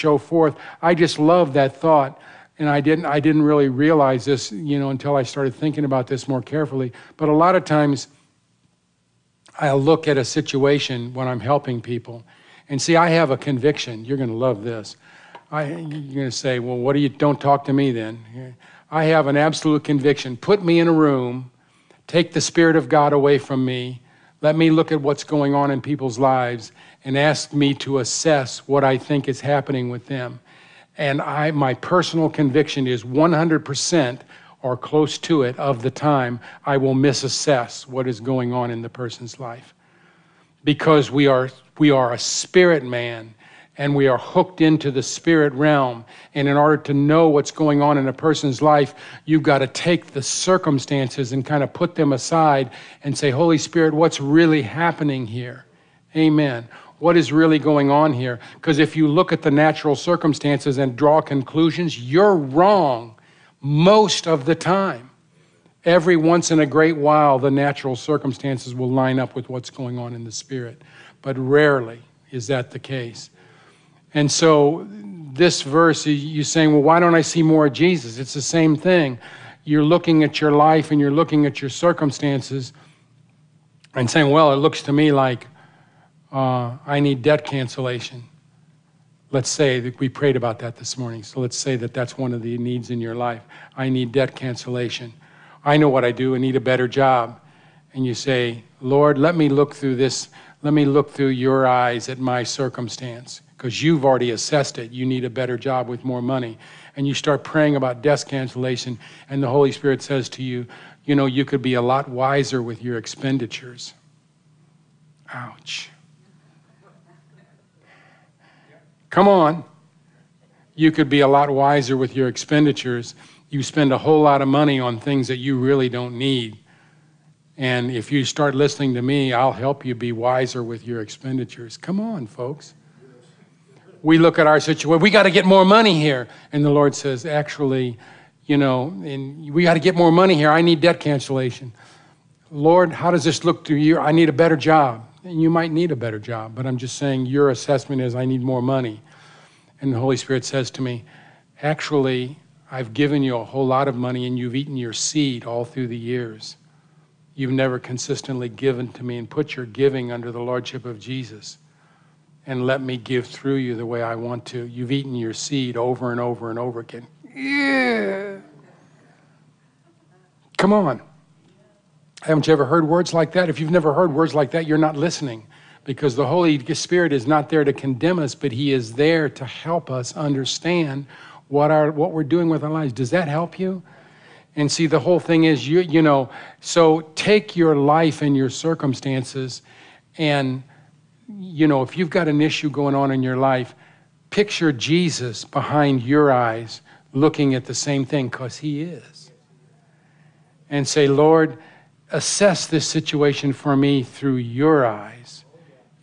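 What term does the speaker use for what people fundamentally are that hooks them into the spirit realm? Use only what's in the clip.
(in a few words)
a spirit man.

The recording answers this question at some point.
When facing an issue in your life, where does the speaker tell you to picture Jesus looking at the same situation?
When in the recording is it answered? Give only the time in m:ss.
3:15.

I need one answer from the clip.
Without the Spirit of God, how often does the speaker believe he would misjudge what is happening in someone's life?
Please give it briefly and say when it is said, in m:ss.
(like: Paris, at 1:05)
100%, at 0:33.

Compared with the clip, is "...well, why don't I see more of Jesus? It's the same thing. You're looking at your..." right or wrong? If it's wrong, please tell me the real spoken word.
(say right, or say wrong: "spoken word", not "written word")
right.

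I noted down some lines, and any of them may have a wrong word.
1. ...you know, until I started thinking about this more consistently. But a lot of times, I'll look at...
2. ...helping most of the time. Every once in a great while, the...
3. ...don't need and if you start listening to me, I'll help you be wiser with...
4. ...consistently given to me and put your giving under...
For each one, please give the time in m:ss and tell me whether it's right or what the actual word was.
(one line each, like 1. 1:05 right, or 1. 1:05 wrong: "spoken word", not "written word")
1. 0:04 wrong: "carefully", not "consistently"
2. 1:02 wrong: "wrong", not "helping"
3. 2:05 right
4. 2:37 right.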